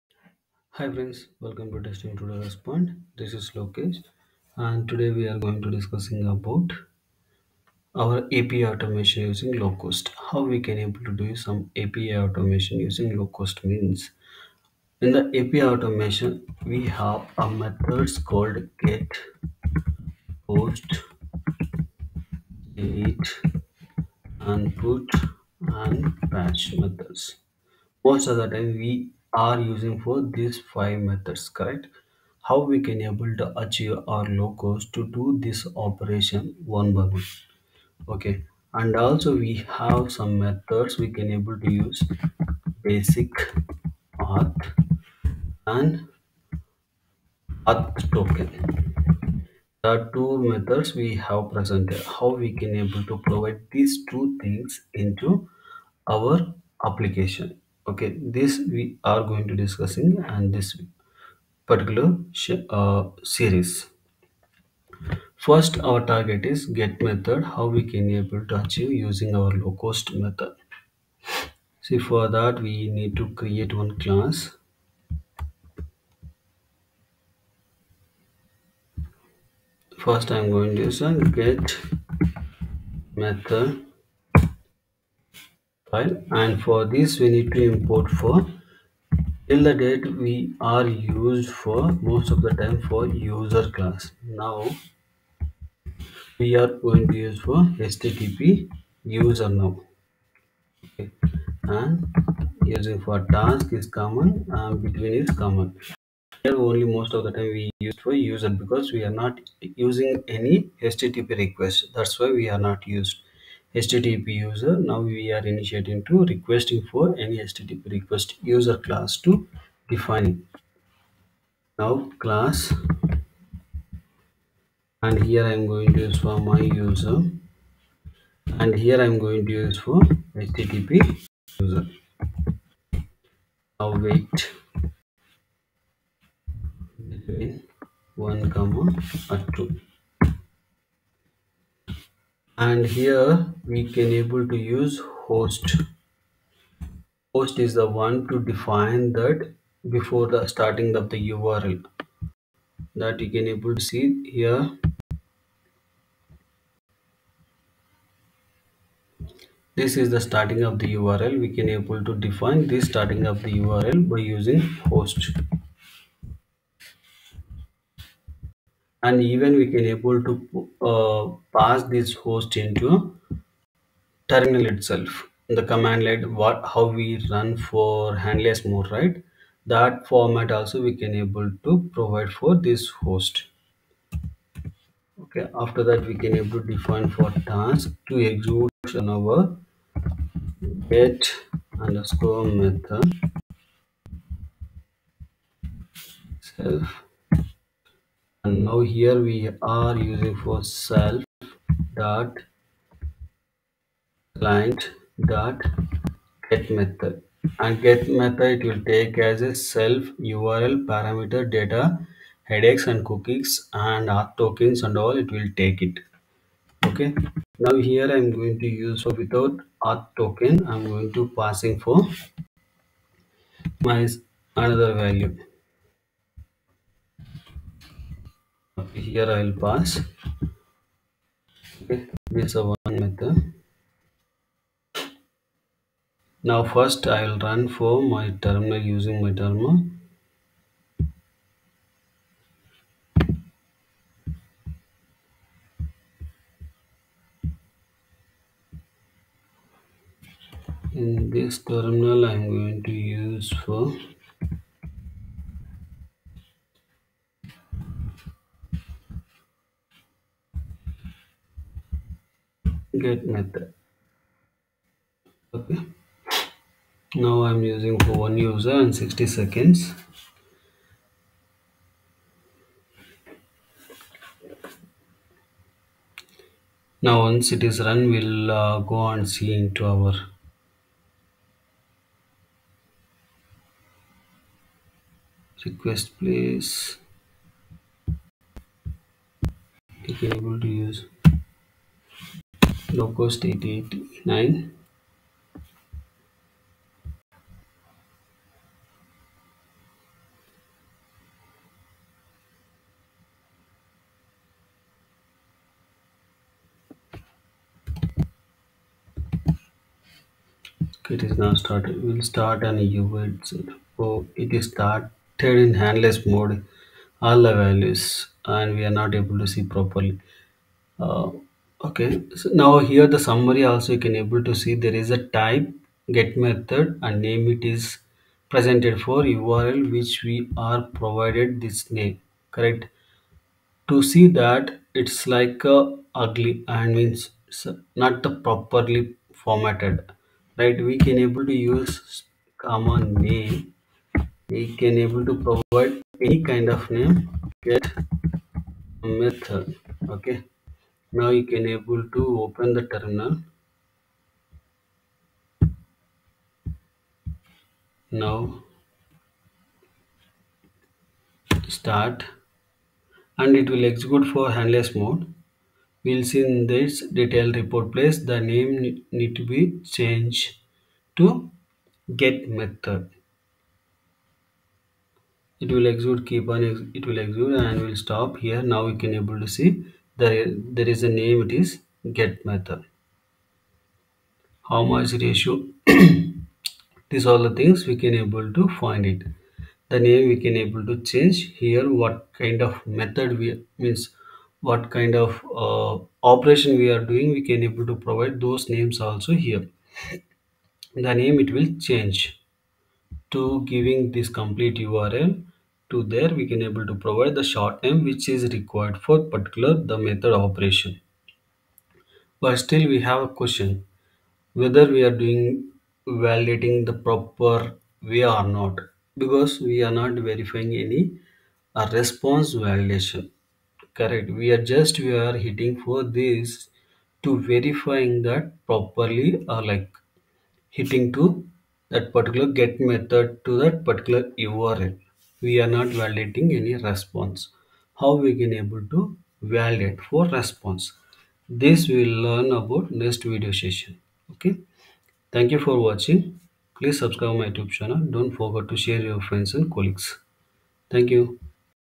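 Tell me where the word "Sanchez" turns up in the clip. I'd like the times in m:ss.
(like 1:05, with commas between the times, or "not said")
not said.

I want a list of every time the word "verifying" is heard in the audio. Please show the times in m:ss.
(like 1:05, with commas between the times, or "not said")
7:00, 7:07.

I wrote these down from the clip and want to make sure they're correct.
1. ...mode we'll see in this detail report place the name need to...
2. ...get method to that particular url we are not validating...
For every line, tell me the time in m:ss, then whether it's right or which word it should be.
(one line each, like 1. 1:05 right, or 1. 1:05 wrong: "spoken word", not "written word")
1. 6:04 right
2. 7:12 right.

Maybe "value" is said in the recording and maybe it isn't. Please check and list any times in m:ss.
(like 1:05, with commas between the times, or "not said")
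3:45, 5:17.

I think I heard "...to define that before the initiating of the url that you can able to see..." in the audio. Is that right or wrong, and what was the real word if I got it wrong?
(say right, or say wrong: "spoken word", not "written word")
wrong: "starting", not "initiating".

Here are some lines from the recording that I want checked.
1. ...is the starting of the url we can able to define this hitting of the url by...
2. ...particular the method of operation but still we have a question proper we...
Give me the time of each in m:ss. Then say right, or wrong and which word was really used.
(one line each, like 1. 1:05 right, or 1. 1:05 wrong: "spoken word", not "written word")
1. 2:40 wrong: "starting", not "hitting"
2. 6:49 wrong: "whether", not "proper".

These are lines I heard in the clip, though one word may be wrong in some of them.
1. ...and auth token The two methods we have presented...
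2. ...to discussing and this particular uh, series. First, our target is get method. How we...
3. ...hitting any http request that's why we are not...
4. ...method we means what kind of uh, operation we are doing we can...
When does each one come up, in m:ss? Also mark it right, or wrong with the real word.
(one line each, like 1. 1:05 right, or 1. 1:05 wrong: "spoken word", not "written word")
1. 0:45 right
2. 0:59 right
3. 1:49 wrong: "using", not "hitting"
4. 6:33 right.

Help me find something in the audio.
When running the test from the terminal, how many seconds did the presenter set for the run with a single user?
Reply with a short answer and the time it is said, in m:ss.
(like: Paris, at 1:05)
60, at 4:28.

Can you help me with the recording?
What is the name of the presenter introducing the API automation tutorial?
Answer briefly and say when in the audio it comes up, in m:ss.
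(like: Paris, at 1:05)
Lokesh, at 0:03.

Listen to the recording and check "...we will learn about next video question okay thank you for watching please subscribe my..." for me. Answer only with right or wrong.
wrong.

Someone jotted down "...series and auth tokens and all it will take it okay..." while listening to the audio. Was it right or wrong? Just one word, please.
wrong.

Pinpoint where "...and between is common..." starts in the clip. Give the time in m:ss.
1:44.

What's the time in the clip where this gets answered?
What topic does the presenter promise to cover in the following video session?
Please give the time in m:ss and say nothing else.
7:01.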